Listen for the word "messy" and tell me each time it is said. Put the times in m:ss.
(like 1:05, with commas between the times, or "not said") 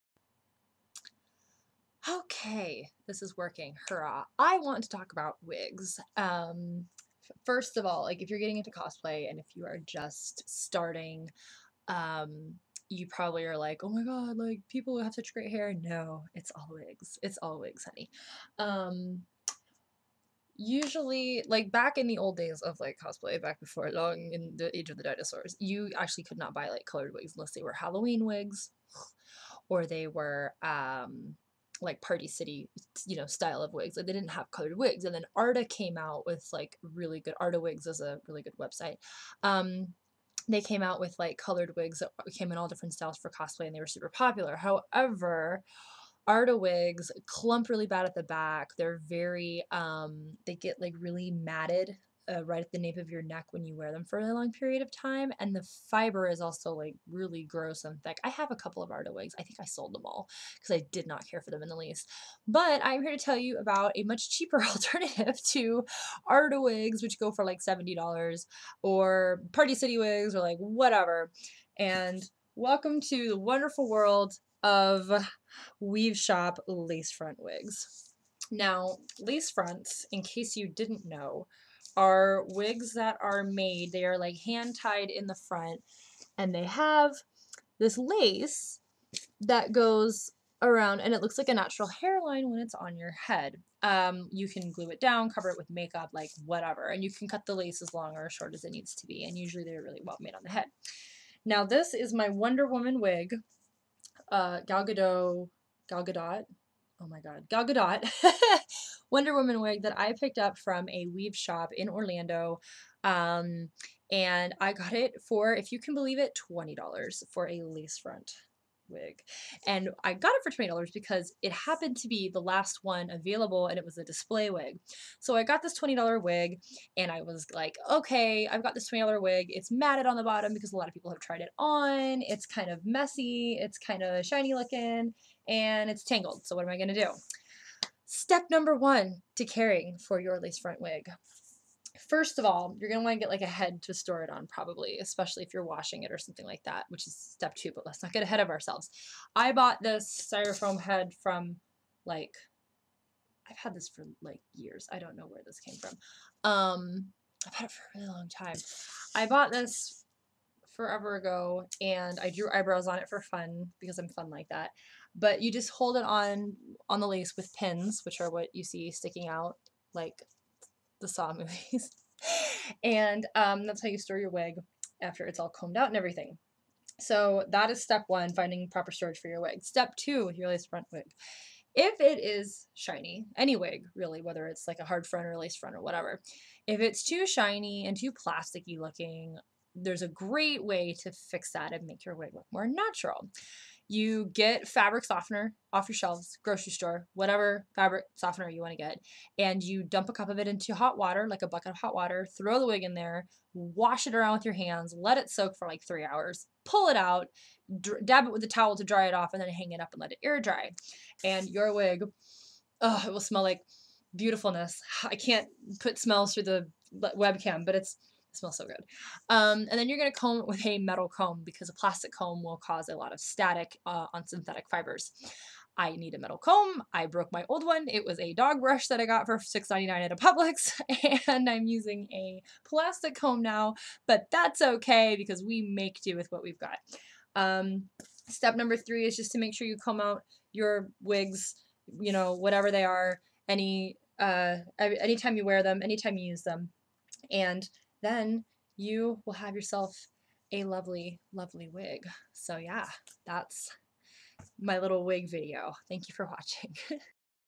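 2:12.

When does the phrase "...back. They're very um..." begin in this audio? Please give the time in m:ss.
0:48.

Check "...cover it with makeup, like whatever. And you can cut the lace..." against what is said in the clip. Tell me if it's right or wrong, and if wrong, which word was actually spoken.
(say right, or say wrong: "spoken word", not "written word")
right.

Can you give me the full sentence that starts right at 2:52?
and um, that's how you store your wig after it's all combed out and everything.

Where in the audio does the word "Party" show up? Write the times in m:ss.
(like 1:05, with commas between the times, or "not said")
0:32, 1:09.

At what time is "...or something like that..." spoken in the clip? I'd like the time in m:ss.
2:26.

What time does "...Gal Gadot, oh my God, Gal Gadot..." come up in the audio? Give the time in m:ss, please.
1:45.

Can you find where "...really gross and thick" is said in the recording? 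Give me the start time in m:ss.
0:57.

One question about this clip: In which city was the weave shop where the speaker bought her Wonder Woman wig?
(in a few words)
Orlando.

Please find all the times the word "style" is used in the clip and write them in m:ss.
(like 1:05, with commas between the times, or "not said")
0:33, 0:42.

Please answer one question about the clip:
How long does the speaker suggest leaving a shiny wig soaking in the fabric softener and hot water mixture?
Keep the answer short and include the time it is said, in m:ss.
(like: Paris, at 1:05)
3 hours, at 3:25.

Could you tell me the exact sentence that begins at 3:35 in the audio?
I can't put smells through the webcam, but it's it smells so good.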